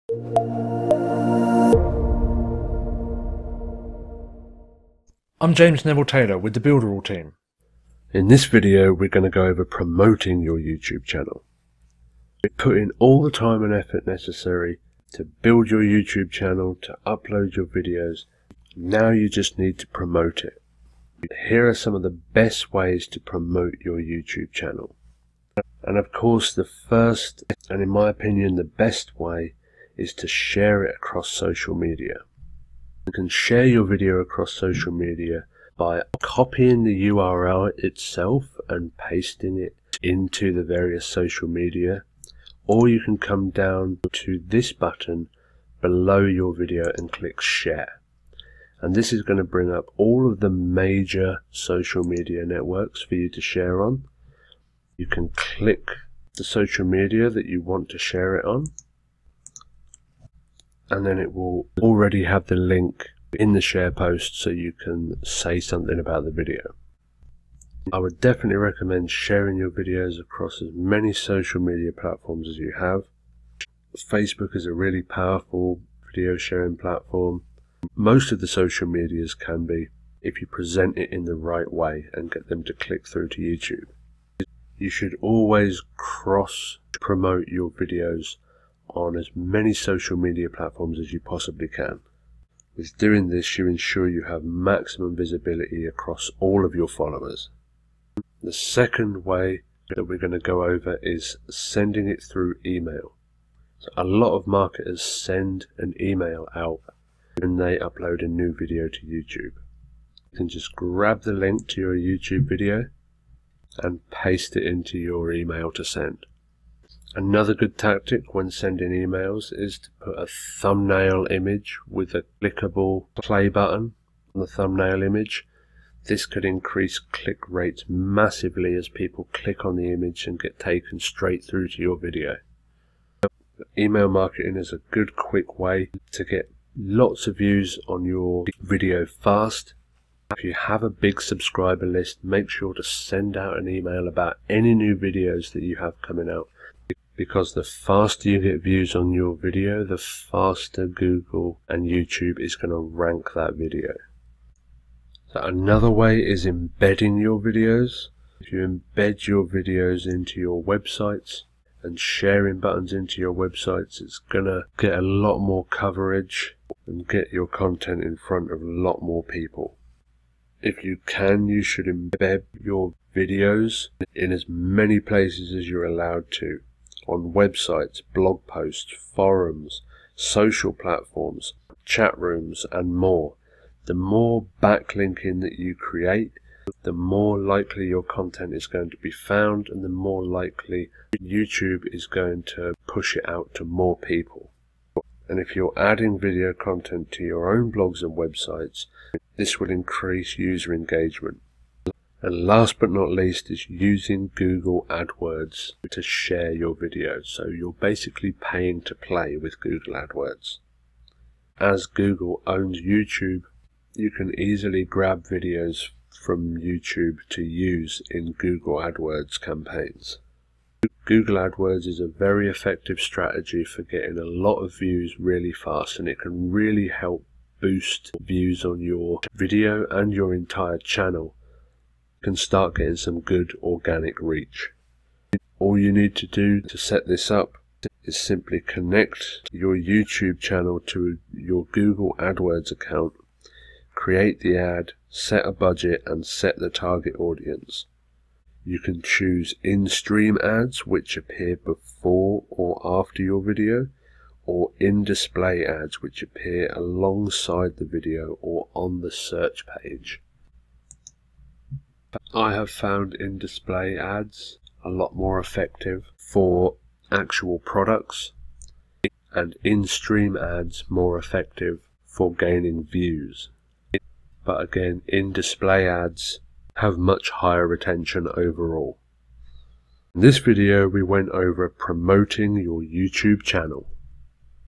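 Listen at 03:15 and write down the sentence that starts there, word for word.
And if you're adding video content to your own blogs and websites, this will increase user engagement.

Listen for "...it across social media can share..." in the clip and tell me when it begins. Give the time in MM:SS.
00:30.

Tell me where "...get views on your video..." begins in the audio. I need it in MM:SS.
02:28.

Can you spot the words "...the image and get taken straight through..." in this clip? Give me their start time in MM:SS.
02:09.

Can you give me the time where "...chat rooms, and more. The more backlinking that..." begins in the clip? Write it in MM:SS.
03:01.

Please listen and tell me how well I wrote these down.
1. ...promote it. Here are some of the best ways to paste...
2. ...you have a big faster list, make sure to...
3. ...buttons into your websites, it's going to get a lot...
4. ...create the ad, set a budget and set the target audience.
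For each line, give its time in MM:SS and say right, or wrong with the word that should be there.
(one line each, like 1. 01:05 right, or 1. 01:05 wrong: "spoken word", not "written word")
1. 00:19 wrong: "promote", not "paste"
2. 02:20 wrong: "subscriber", not "faster"
3. 02:42 right
4. 04:03 right.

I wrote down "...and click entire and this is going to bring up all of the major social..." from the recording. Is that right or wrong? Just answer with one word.
wrong.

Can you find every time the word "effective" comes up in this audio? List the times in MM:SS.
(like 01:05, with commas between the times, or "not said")
03:42, 04:25, 04:31.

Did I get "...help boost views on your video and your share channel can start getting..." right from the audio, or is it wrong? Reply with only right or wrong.
wrong.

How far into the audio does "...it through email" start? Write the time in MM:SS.
01:42.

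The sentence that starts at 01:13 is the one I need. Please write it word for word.
Facebook is a really powerful video sharing platform.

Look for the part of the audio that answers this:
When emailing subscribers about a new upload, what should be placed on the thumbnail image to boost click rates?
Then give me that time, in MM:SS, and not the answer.
02:02.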